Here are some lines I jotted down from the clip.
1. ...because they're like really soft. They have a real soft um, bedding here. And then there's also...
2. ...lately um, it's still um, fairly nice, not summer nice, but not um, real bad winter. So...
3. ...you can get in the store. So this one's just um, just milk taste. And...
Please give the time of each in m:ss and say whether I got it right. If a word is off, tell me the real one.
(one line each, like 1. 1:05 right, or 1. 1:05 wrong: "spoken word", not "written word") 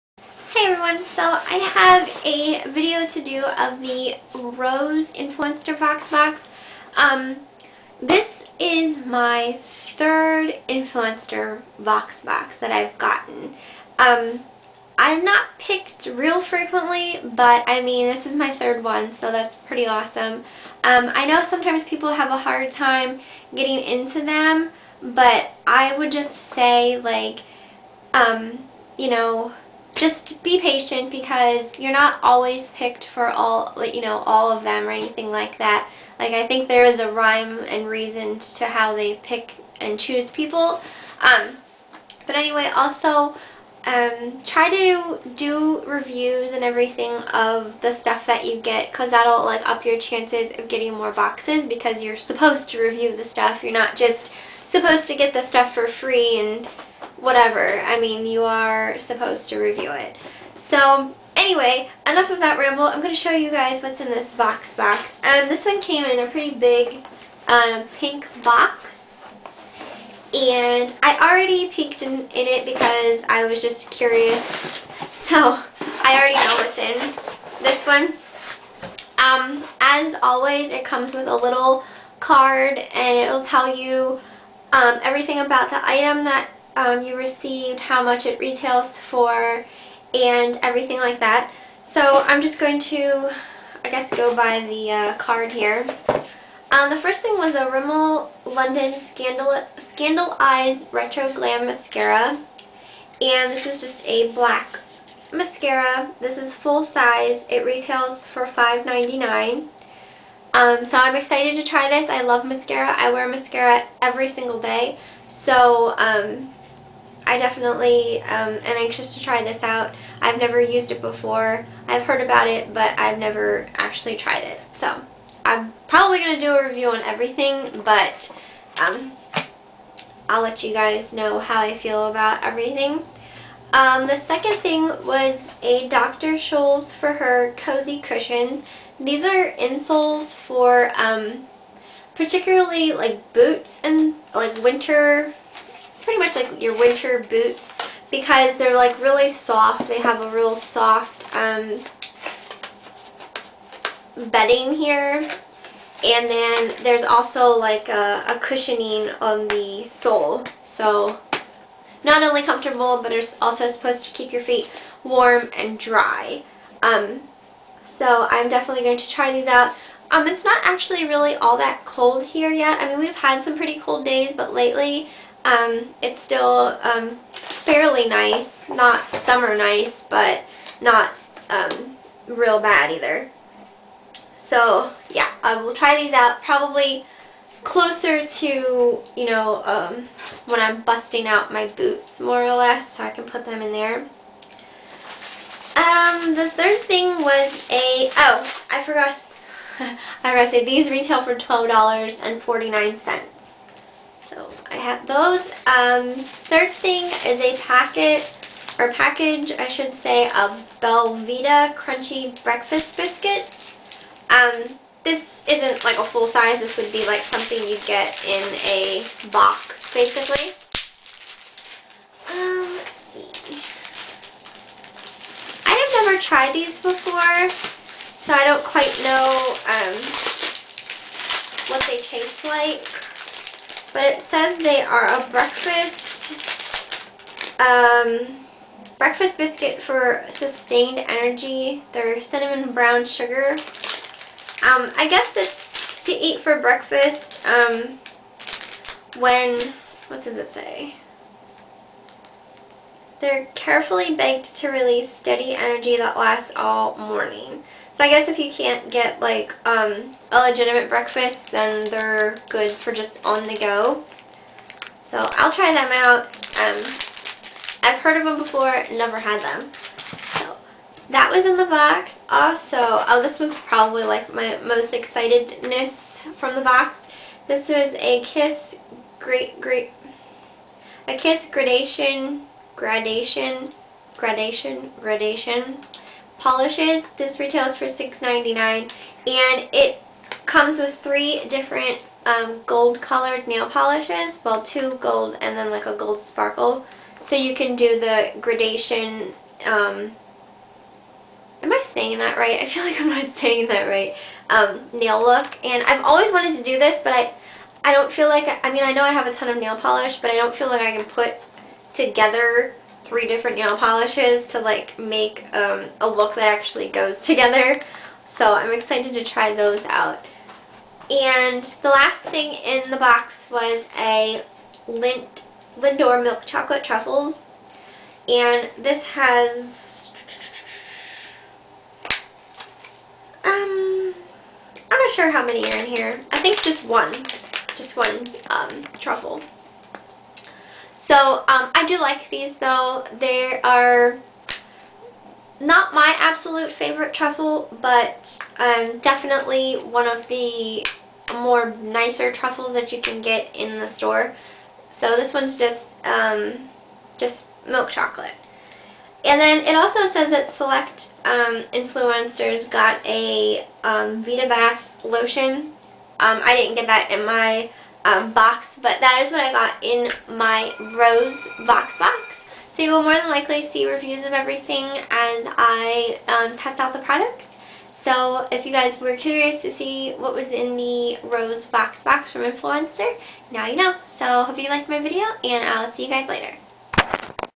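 1. 2:28 right
2. 2:54 wrong: "either", not "winter"
3. 5:52 wrong: "chocolate", not "taste".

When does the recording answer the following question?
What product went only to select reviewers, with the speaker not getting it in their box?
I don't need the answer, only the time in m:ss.
6:04.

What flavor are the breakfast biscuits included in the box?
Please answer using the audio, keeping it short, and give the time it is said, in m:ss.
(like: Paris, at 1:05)
Cinnamon brown sugar, at 4:02.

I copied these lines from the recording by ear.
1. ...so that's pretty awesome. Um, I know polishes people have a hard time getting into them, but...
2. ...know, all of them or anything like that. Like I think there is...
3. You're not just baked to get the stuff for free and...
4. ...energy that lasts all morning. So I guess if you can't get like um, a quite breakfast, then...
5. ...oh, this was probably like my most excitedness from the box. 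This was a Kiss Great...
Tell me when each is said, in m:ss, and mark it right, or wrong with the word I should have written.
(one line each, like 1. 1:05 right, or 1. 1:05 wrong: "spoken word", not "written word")
1. 0:19 wrong: "sometimes", not "polishes"
2. 0:34 right
3. 0:53 wrong: "supposed", not "baked"
4. 4:15 wrong: "legitimate", not "quite"
5. 4:32 right.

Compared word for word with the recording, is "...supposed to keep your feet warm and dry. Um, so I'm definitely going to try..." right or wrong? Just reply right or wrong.
right.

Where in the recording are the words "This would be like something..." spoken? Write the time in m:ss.
3:36.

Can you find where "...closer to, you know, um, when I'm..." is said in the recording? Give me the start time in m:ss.
3:07.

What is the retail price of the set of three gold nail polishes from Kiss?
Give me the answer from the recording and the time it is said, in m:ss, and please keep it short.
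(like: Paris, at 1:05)
$6.99, at 4:47.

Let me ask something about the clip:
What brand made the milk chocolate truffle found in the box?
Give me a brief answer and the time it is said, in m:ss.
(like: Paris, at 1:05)
Lindor, at 5:24.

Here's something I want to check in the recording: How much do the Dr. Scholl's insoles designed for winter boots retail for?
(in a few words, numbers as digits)
$12.49.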